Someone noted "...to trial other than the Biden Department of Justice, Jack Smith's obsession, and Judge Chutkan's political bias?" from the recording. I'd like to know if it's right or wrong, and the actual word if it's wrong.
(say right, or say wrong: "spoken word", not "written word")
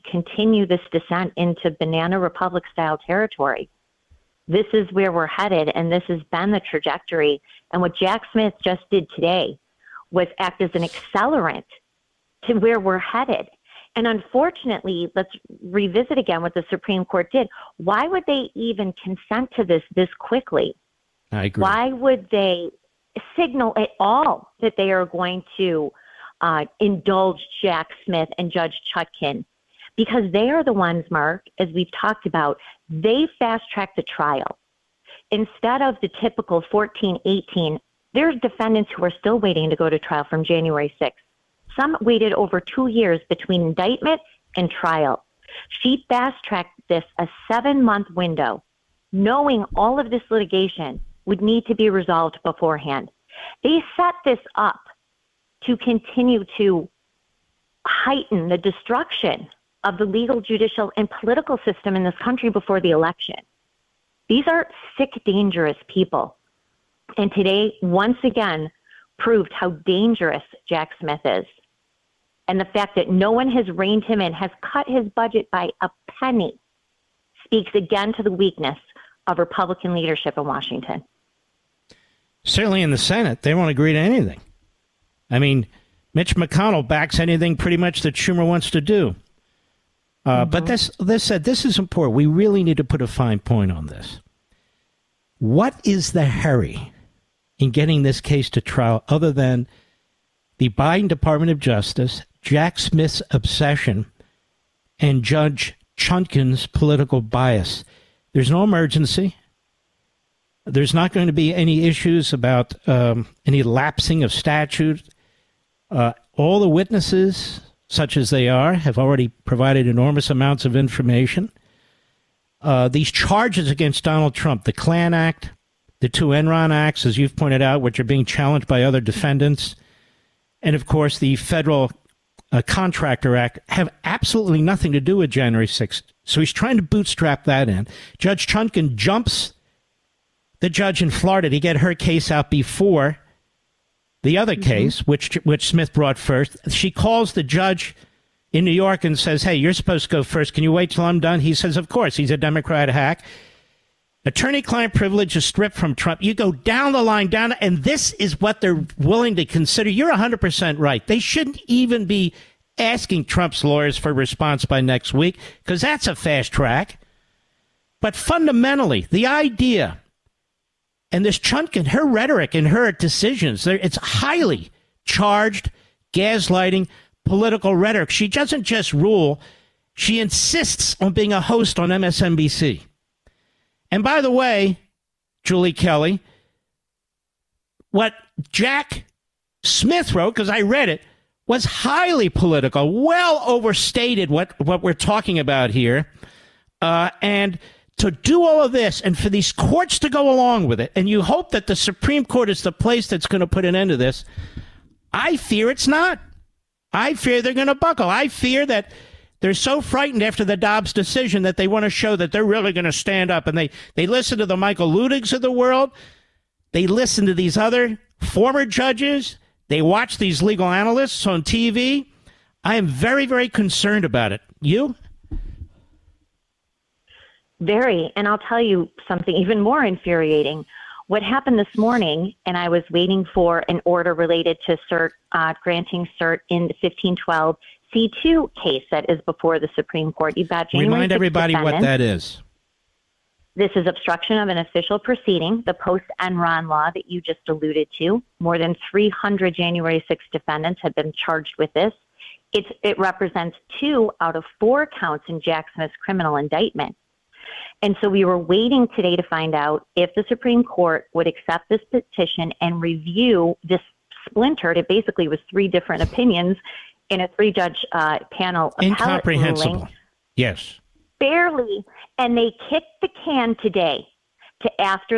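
right.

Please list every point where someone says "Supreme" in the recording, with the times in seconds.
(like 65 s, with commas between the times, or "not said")
16 s, 201 s, 239 s, 260 s.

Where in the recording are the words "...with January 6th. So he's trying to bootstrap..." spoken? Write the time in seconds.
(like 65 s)
135 s.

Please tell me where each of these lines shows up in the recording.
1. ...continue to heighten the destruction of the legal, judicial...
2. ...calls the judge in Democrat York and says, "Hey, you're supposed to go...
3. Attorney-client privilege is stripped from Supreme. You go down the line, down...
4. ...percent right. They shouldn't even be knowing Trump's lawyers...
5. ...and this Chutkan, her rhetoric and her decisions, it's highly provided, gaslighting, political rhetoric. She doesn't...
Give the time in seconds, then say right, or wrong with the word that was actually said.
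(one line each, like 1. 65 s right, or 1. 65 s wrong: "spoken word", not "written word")
1. 55 s right
2. 146 s wrong: "New", not "Democrat"
3. 154 s wrong: "Trump", not "Supreme"
4. 160 s wrong: "asking", not "knowing"
5. 171 s wrong: "charged", not "provided".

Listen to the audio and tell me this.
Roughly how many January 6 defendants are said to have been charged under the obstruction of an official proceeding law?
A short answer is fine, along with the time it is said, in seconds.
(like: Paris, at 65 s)
More than 300, at 248 s.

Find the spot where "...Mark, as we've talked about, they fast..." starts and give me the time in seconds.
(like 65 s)
31 s.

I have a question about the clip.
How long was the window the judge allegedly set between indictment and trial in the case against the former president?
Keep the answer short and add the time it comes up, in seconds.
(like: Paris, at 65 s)
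7 months, at 47 s.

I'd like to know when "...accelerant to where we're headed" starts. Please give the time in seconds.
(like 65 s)
10 s.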